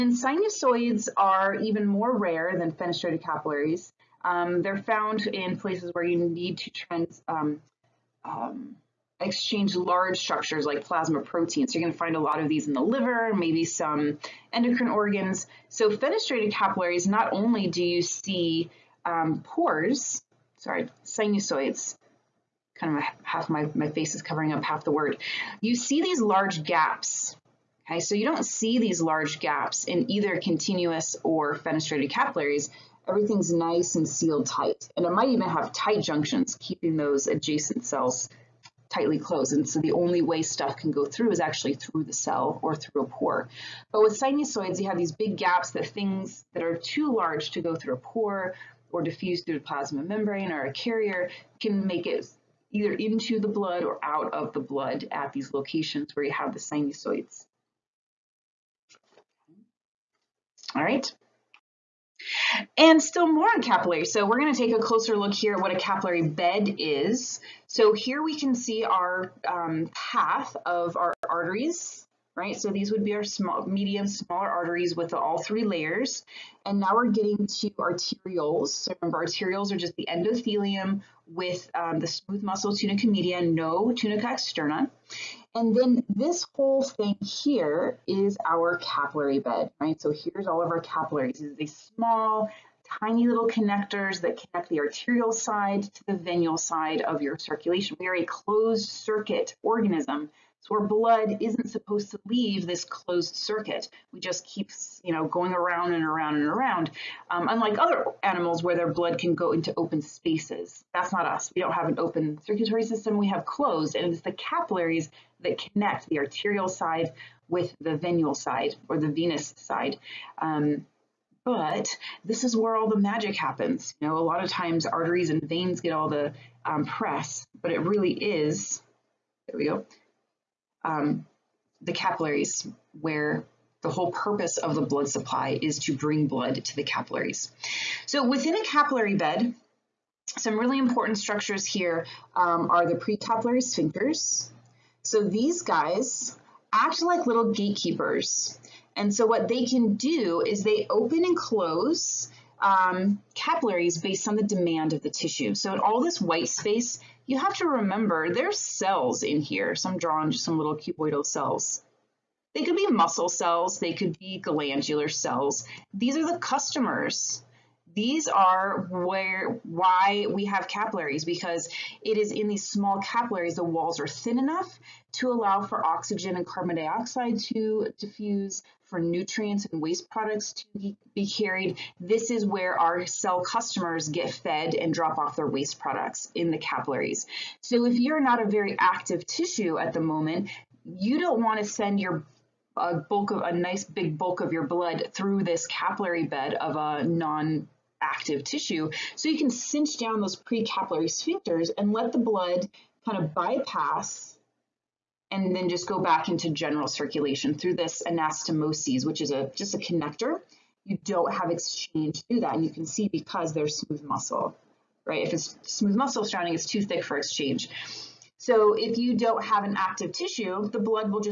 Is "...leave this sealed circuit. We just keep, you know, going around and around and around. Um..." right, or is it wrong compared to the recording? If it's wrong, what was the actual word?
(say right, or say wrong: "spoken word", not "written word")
wrong: "closed", not "sealed".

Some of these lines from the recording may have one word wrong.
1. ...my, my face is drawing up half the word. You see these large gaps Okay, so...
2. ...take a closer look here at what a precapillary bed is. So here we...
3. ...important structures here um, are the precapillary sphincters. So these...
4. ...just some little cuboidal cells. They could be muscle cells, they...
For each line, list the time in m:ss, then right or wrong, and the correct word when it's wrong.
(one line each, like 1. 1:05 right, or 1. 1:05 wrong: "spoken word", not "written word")
1. 0:23 wrong: "covering", not "drawing"
2. 1:04 wrong: "capillary", not "precapillary"
3. 2:20 right
4. 2:40 right.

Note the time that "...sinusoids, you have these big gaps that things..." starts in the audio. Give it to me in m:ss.
0:44.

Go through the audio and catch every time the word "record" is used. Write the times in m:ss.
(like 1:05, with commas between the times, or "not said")
not said.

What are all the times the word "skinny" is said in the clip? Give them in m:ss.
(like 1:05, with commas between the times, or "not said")
not said.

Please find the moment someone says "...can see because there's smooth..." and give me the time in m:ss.
3:32.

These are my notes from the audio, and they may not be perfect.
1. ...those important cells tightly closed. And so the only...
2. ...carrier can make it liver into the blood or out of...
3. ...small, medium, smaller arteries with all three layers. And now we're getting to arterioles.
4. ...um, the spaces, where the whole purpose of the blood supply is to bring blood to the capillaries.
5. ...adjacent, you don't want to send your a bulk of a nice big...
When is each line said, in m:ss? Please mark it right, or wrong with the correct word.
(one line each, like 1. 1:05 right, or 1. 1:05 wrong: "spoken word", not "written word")
1. 0:36 wrong: "adjacent", not "important"
2. 0:50 wrong: "either", not "liver"
3. 1:13 right
4. 2:10 wrong: "capillaries", not "spaces"
5. 3:09 wrong: "moment", not "adjacent".